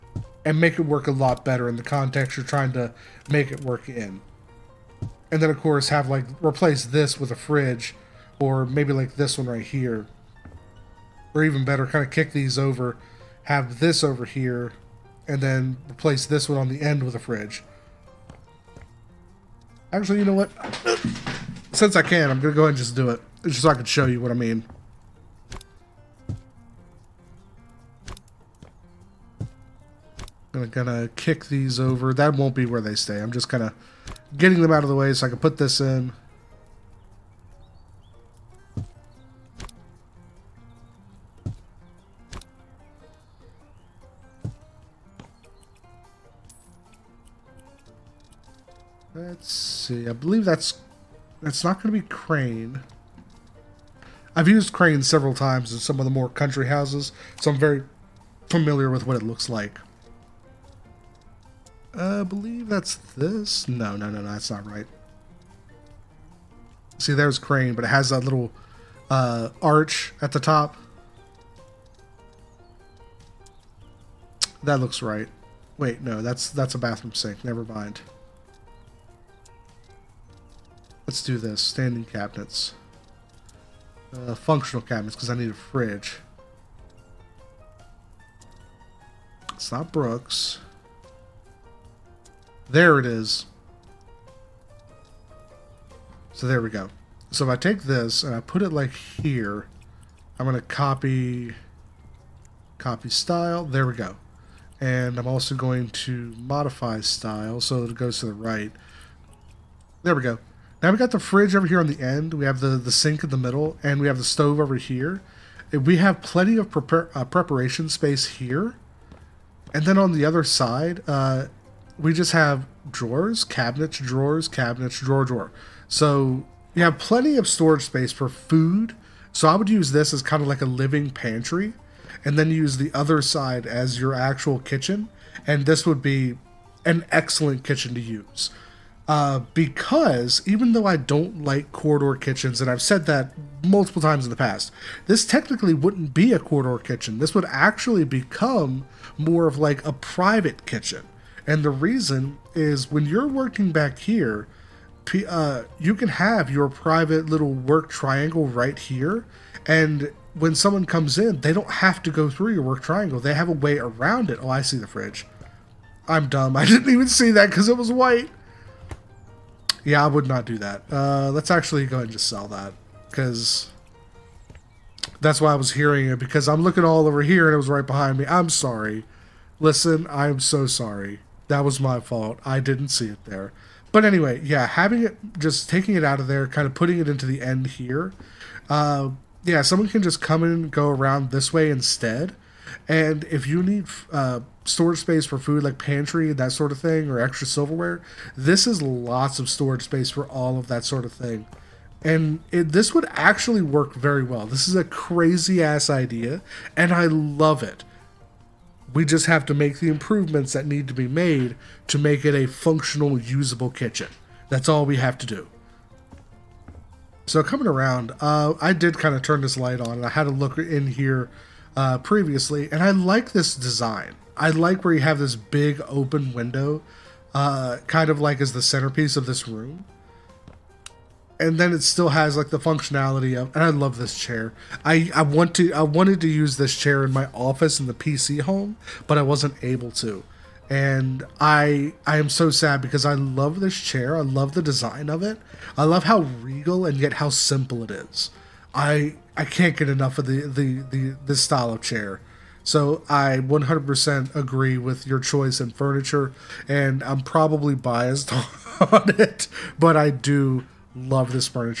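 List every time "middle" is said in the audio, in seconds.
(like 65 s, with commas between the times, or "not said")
113 s.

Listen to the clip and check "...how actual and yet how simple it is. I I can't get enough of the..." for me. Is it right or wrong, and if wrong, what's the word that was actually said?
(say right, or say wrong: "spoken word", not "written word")
wrong: "regal", not "actual".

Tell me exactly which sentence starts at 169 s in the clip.
Yeah, I would not do that.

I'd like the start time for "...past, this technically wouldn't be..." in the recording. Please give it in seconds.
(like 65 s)
144 s.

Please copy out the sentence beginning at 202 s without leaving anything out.
And it, this would actually work very well.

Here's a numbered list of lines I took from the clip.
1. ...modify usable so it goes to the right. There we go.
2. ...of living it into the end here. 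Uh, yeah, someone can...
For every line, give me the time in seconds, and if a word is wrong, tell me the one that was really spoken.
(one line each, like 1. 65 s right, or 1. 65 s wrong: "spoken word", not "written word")
1. 106 s wrong: "style", not "usable"
2. 186 s wrong: "putting", not "living".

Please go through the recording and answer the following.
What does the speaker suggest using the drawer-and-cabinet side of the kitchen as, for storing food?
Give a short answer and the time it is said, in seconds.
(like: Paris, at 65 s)
A living pantry, at 130 s.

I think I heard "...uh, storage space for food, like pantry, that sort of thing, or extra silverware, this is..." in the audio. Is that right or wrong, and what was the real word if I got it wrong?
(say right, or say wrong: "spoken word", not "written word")
right.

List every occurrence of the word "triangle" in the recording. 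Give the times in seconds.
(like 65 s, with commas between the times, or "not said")
157 s, 162 s.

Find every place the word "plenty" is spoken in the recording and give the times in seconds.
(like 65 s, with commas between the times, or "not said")
116 s, 126 s.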